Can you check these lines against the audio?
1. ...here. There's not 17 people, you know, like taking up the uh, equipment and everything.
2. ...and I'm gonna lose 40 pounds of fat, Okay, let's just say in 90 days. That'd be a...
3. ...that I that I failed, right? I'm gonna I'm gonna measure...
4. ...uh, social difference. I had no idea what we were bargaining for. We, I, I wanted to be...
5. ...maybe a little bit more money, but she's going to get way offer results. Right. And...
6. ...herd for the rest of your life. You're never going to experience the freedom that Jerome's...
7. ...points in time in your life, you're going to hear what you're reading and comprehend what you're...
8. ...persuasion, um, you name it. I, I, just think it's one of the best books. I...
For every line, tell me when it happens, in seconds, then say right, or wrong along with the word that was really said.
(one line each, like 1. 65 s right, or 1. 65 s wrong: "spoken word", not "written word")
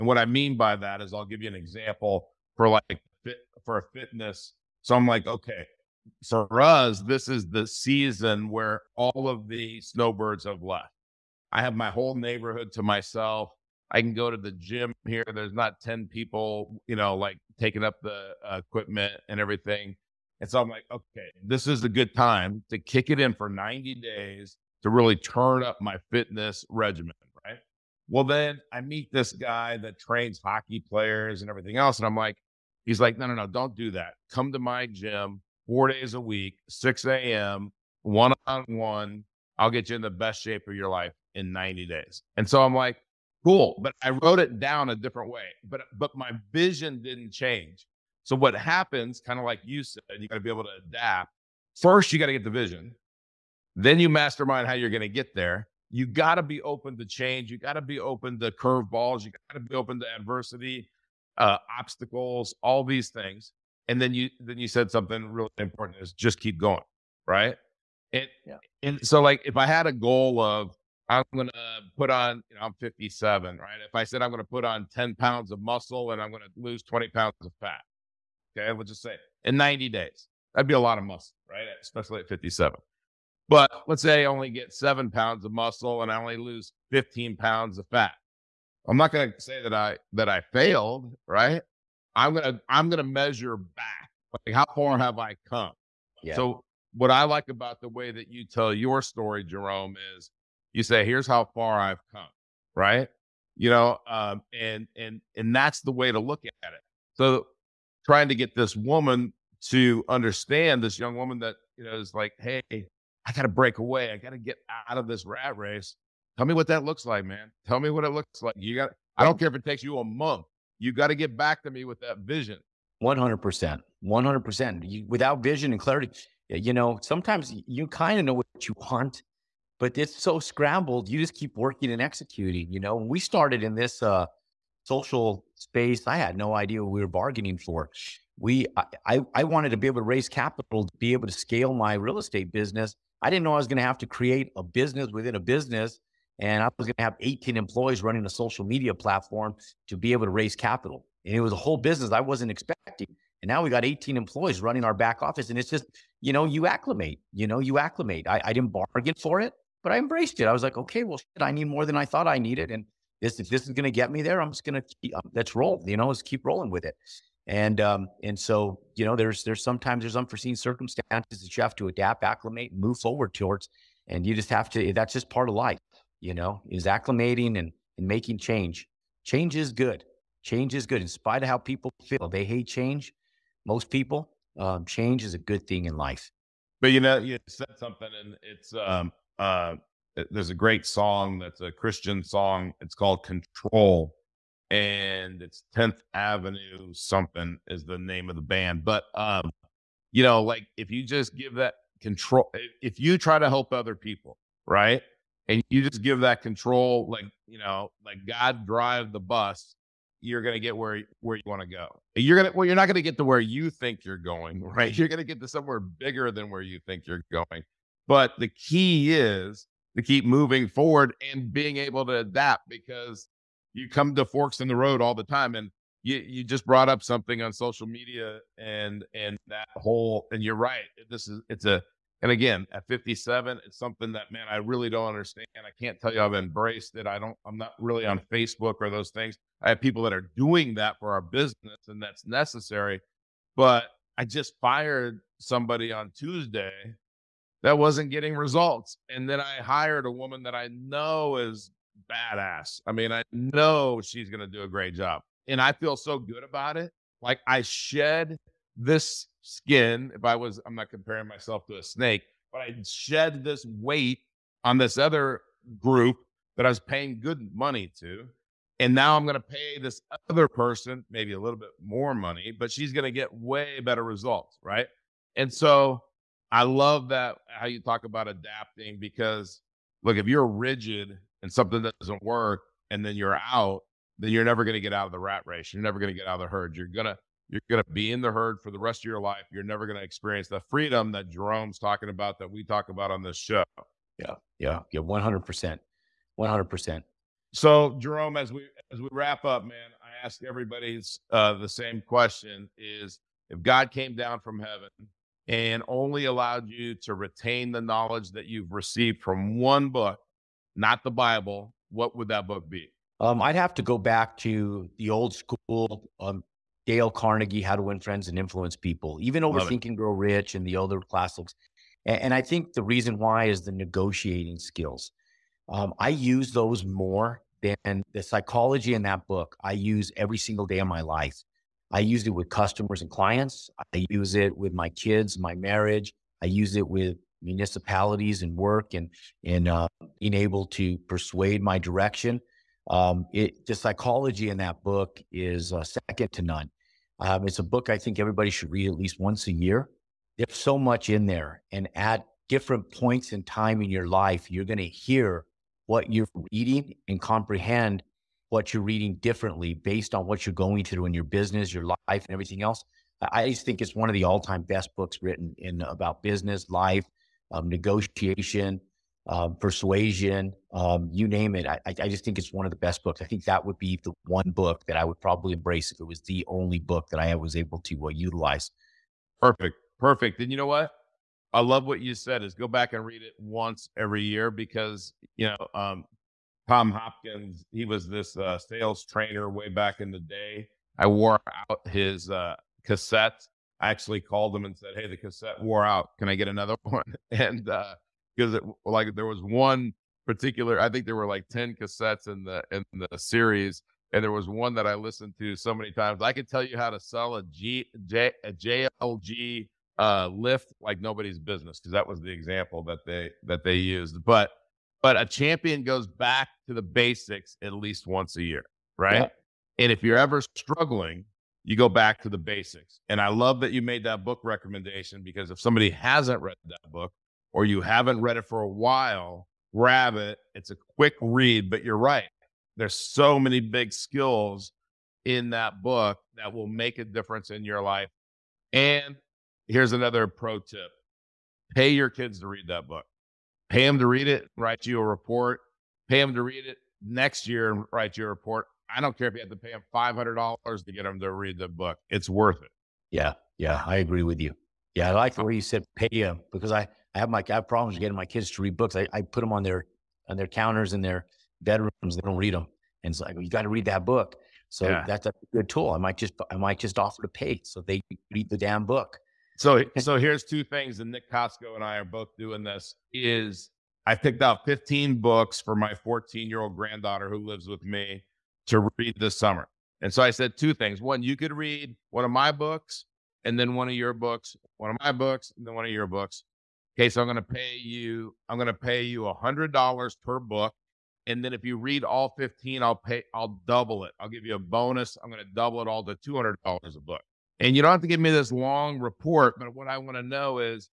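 1. 15 s wrong: "10", not "17"
2. 76 s wrong: "20", not "40"
3. 89 s right
4. 134 s wrong: "space", not "difference"
5. 271 s wrong: "better", not "offer"
6. 288 s right
7. 352 s right
8. 369 s right.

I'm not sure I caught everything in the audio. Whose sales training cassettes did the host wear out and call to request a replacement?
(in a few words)
Tom Hopkins.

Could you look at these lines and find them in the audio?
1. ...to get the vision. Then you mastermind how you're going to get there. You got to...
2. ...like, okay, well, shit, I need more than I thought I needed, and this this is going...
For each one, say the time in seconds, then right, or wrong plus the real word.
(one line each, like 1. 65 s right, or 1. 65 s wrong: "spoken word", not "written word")
1. 52 s right
2. 160 s right.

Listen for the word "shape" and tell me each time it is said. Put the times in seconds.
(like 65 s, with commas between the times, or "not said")
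40 s.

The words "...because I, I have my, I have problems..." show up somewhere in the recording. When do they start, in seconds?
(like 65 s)
456 s.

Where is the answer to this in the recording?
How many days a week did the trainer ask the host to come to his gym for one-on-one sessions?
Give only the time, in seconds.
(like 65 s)
35 s.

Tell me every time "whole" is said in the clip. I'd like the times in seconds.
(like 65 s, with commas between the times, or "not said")
11 s, 151 s, 229 s.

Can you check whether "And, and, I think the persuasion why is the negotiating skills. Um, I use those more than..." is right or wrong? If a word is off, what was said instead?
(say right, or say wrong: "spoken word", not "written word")
wrong: "reason", not "persuasion".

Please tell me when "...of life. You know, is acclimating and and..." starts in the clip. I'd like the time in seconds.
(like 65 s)
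175 s.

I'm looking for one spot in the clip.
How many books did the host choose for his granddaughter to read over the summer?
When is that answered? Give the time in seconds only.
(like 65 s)
474 s.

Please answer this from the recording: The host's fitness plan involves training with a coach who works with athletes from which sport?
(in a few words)
hockey.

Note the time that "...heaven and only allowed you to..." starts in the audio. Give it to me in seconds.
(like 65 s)
304 s.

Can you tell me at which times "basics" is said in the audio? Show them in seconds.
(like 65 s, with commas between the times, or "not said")
416 s, 422 s.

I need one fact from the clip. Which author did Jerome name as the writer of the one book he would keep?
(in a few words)
Dale Carnegie.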